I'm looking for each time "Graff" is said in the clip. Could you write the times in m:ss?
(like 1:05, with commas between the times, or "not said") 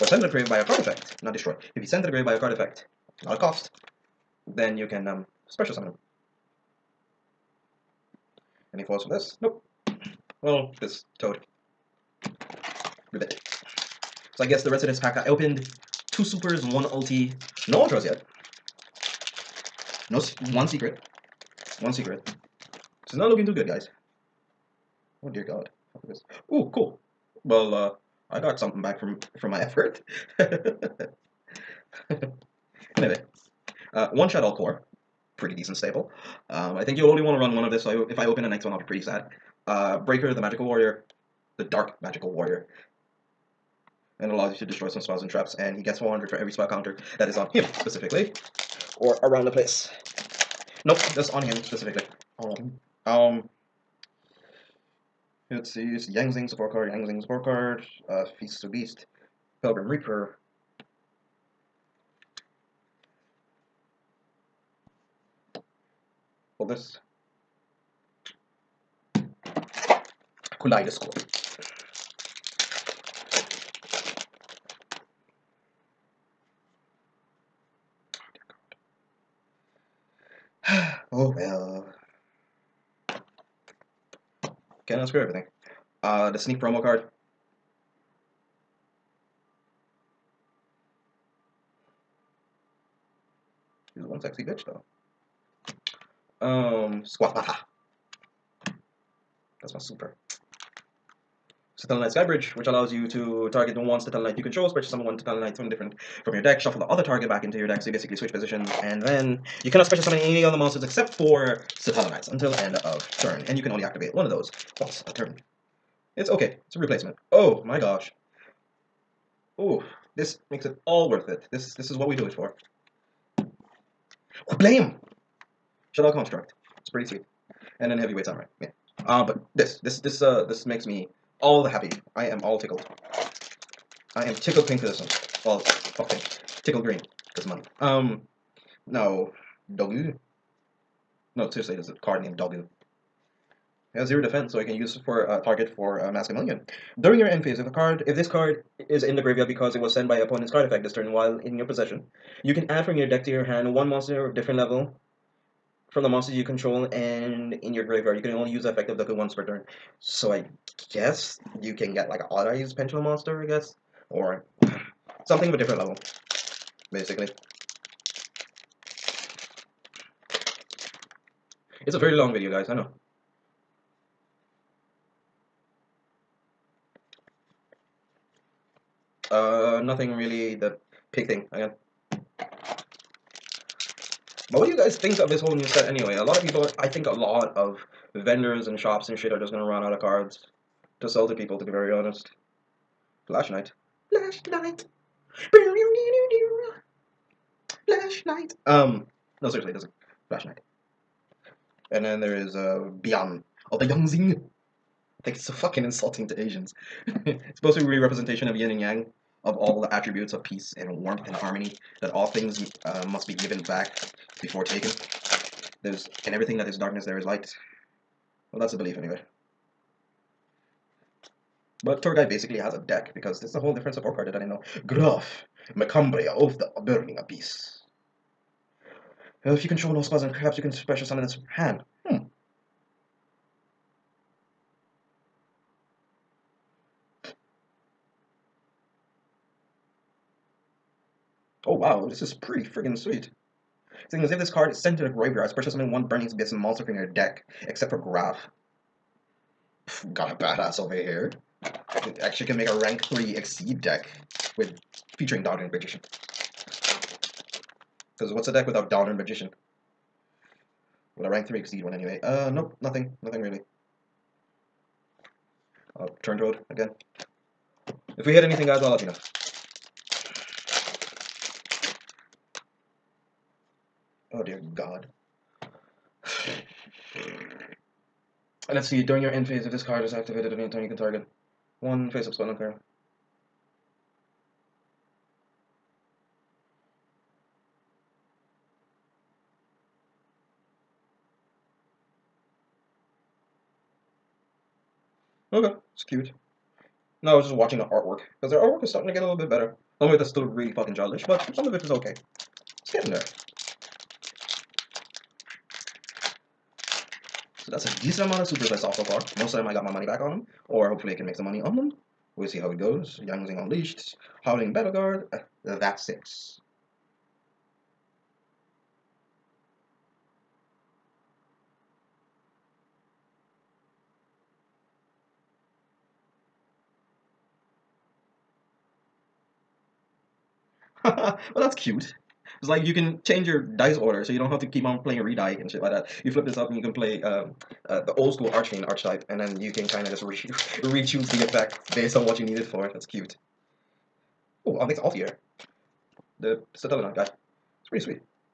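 3:44, 4:07.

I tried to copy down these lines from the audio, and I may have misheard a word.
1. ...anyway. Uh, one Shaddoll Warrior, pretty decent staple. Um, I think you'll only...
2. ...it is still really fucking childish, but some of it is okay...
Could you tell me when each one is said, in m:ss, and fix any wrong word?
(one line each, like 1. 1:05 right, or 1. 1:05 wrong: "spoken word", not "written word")
1. 0:32 wrong: "Core", not "Warrior"
2. 5:00 right.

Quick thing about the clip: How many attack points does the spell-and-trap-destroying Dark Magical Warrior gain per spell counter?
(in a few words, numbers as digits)
400.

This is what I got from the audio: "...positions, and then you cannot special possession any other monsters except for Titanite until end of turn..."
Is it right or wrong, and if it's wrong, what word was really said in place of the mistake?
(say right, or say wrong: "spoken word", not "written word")
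wrong: "summon", not "possession".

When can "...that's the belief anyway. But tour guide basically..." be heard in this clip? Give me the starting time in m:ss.
3:38.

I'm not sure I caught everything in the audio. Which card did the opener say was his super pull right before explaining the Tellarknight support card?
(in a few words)
Squamata.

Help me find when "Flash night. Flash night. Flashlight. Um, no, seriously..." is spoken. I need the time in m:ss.
3:13.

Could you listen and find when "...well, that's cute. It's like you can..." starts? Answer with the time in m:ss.
5:31.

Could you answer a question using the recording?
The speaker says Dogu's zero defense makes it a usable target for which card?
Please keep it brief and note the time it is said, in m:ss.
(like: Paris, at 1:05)
Mask Million, at 2:26.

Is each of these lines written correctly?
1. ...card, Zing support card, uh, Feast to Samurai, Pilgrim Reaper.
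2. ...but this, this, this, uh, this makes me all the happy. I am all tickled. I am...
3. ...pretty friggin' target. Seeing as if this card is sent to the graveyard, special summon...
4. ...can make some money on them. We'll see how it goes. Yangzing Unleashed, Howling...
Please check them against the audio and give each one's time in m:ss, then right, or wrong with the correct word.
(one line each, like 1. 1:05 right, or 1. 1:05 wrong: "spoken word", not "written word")
1. 0:56 wrong: "Beast", not "Samurai"
2. 2:09 right
3. 4:02 wrong: "sweet", not "target"
4. 5:11 right.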